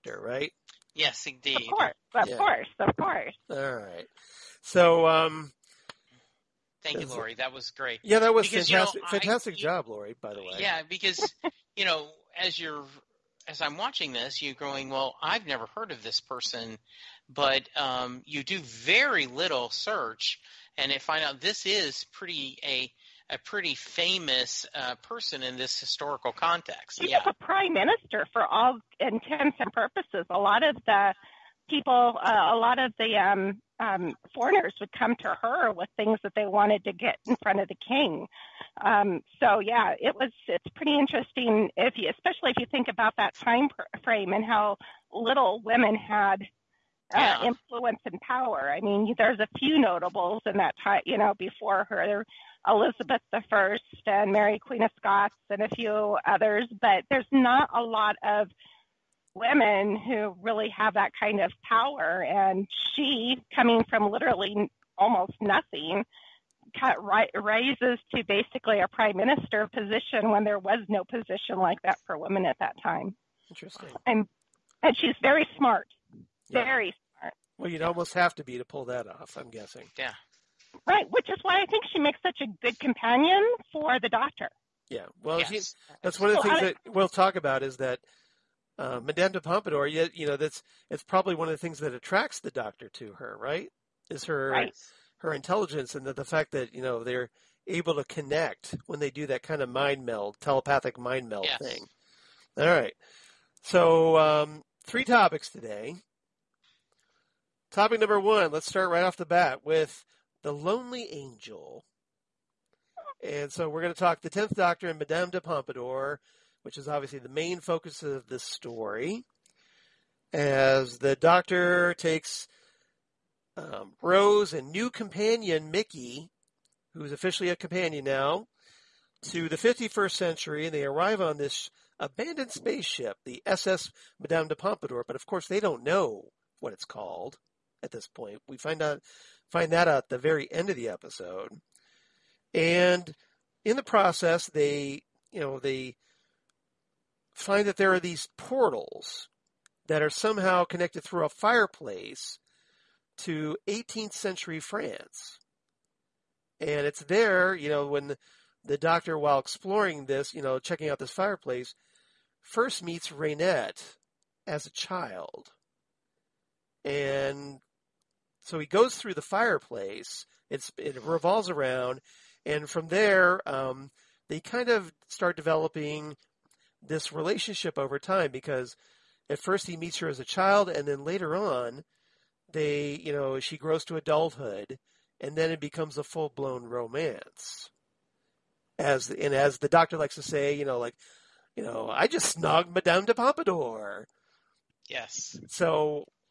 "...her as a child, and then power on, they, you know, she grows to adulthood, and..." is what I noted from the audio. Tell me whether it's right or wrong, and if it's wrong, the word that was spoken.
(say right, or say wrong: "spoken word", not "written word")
wrong: "later", not "power".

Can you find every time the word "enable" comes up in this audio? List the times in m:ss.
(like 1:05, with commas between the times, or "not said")
not said.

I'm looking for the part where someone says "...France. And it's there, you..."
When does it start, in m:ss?
2:34.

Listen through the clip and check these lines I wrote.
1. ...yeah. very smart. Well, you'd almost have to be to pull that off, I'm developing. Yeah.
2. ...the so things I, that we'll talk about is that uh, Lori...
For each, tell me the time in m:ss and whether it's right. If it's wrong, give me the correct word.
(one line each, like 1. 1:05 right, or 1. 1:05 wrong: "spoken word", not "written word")
1. 1:16 wrong: "guessing", not "developing"
2. 1:26 wrong: "Madame", not "Lori".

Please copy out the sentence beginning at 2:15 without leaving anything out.
But of course, they don't know what it's called at this point.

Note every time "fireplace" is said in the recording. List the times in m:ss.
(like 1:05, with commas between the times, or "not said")
2:31, 2:41, 2:49.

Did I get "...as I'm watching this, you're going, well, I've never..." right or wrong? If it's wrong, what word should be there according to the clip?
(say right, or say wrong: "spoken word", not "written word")
right.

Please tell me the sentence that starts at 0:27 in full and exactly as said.
was a prime minister for all intents and purposes.